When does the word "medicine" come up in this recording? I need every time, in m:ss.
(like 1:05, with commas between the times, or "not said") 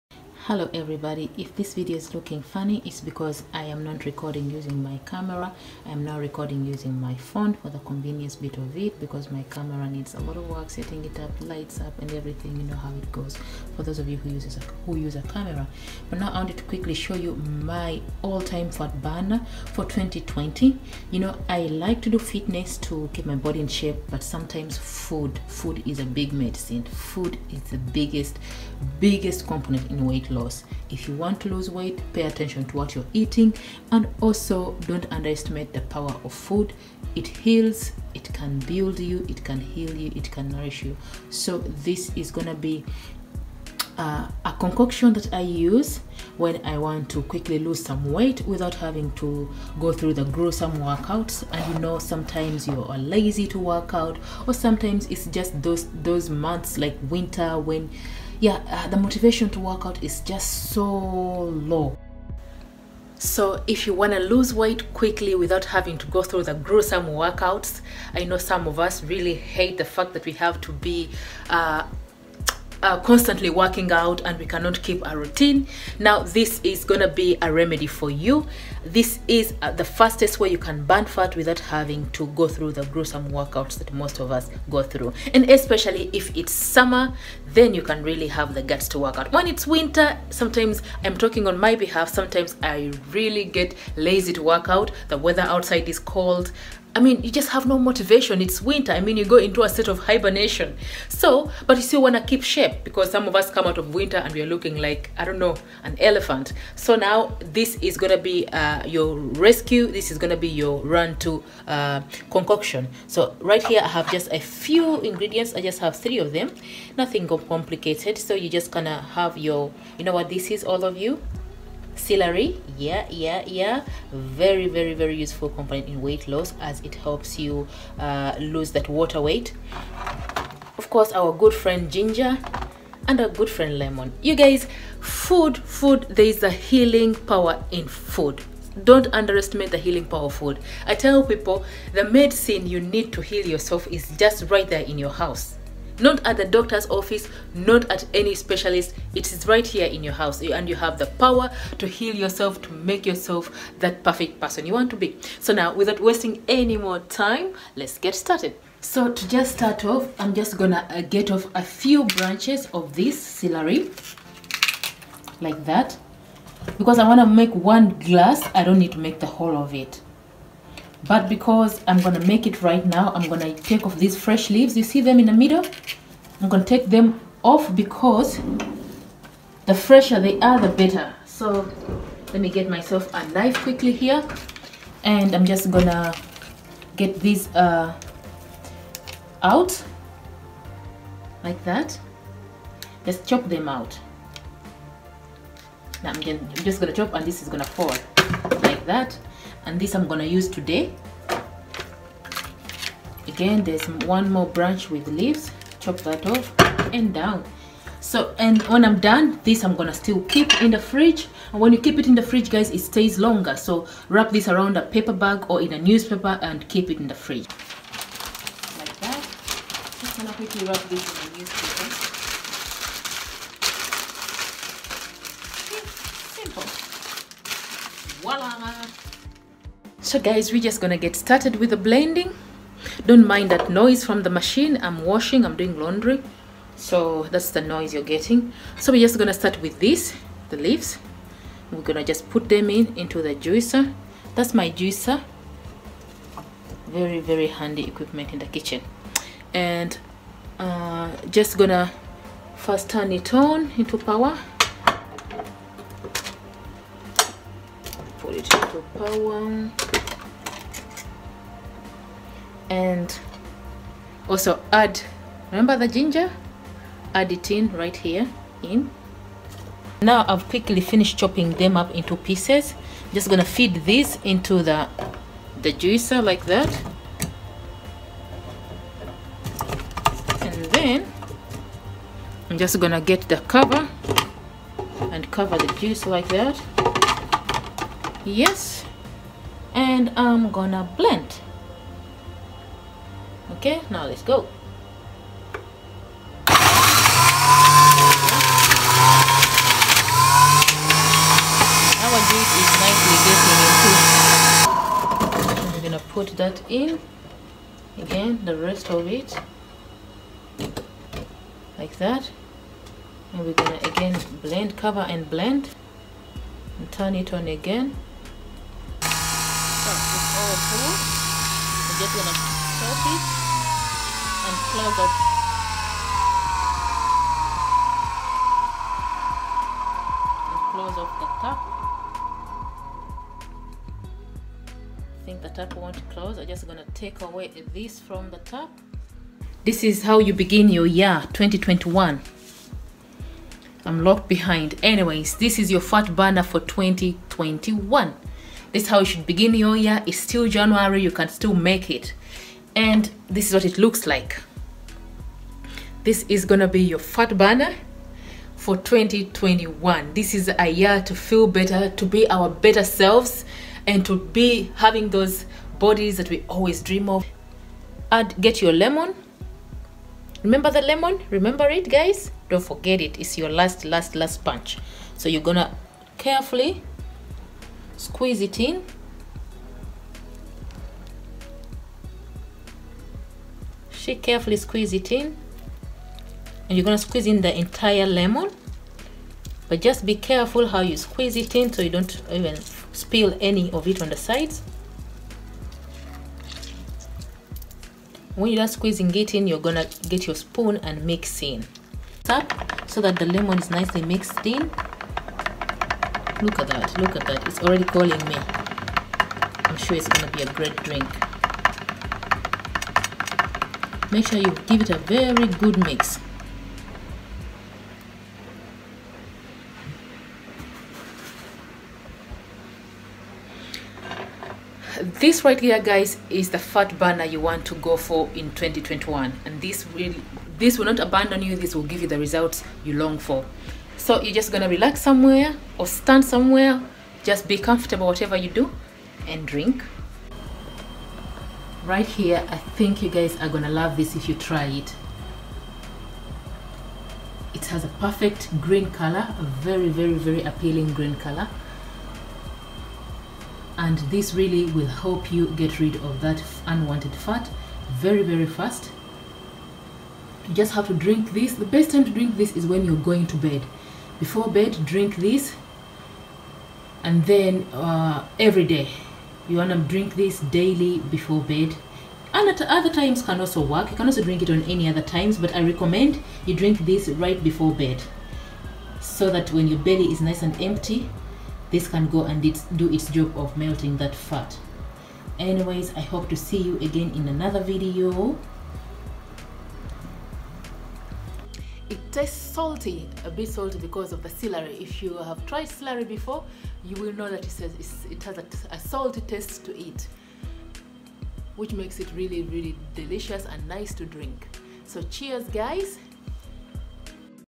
0:26, 2:22.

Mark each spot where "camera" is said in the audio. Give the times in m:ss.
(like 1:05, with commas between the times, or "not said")
0:05, 0:09, 0:15.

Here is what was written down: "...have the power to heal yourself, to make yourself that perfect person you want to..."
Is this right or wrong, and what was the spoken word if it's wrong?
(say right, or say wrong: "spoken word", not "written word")
right.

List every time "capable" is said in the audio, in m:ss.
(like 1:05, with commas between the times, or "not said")
not said.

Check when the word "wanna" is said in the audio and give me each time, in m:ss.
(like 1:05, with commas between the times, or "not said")
2:47.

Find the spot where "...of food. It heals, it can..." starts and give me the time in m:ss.
0:36.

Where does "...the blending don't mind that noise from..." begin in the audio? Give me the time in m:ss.
3:51.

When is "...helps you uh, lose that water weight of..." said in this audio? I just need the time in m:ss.
2:06.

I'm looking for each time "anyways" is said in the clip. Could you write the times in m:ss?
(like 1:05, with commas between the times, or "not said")
5:44, 8:05.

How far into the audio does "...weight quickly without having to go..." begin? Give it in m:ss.
1:04.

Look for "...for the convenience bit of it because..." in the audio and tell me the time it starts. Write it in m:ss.
0:07.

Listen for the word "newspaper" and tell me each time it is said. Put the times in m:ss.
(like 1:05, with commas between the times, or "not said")
3:35, 3:41.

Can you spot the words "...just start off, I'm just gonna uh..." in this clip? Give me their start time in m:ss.
2:39.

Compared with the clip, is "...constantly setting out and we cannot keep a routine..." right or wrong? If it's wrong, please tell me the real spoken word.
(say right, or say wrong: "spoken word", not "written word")
wrong: "working", not "setting".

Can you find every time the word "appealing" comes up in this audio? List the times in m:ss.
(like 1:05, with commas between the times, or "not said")
7:30.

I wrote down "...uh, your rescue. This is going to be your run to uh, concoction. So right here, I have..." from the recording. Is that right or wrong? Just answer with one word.
right.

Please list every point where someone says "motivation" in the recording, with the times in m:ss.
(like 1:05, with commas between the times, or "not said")
0:58, 1:37.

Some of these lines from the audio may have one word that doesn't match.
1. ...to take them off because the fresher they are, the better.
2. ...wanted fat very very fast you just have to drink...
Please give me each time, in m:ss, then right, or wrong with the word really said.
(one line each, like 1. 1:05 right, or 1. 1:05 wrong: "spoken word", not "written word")
1. 2:56 right
2. 7:36 wrong: "unwanted", not "wanted".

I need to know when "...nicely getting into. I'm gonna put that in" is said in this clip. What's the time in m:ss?
5:02.